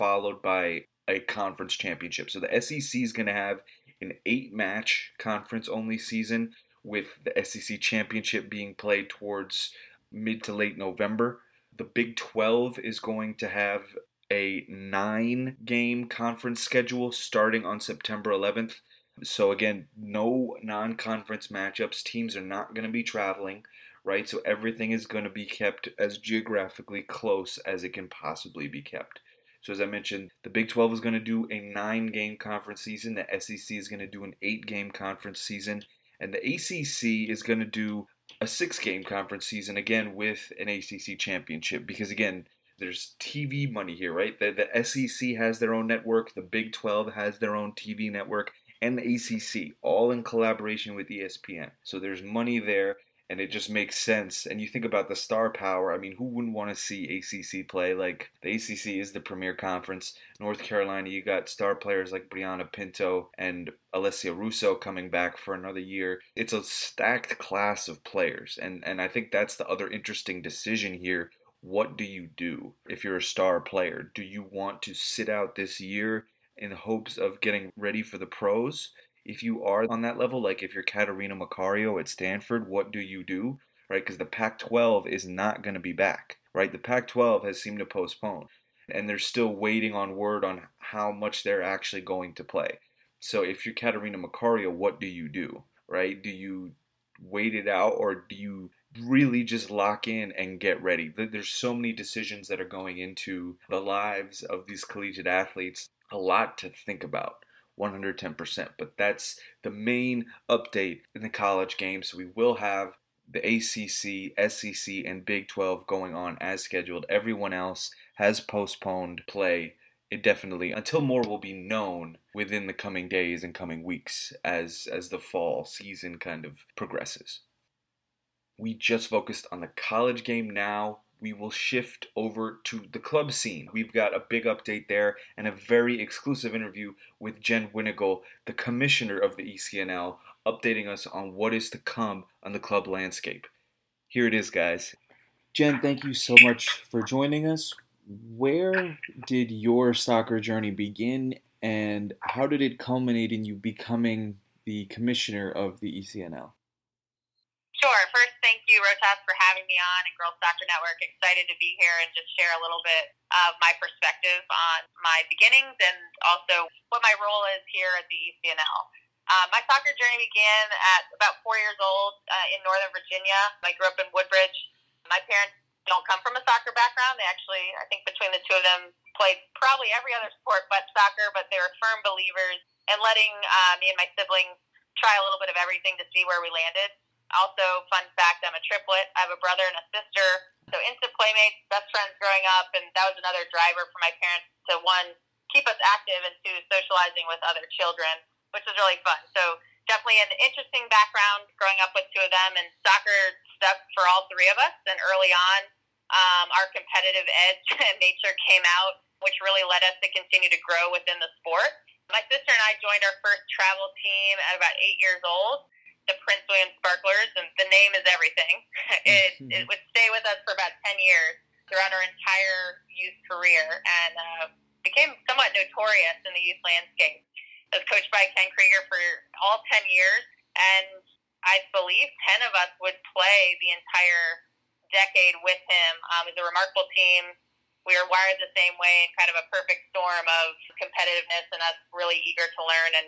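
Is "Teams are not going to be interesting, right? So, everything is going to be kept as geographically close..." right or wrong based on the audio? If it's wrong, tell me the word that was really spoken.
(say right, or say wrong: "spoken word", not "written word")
wrong: "traveling", not "interesting".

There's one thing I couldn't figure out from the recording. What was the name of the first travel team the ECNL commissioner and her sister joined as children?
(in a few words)
Prince William Sparklers.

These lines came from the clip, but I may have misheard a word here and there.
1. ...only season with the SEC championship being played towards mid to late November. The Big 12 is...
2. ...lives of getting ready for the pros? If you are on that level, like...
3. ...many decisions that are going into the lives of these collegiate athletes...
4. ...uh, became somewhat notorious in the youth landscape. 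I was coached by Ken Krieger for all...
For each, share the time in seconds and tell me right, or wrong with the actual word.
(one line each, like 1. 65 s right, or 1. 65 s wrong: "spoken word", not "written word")
1. 5 s right
2. 76 s wrong: "hopes", not "lives"
3. 101 s right
4. 224 s right.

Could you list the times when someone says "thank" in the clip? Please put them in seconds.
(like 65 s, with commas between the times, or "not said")
145 s, 158 s.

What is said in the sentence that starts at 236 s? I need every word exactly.
Um, it was a remarkable team.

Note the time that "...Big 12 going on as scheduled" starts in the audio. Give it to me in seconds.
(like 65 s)
115 s.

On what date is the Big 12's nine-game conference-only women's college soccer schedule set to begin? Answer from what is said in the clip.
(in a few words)
September 11.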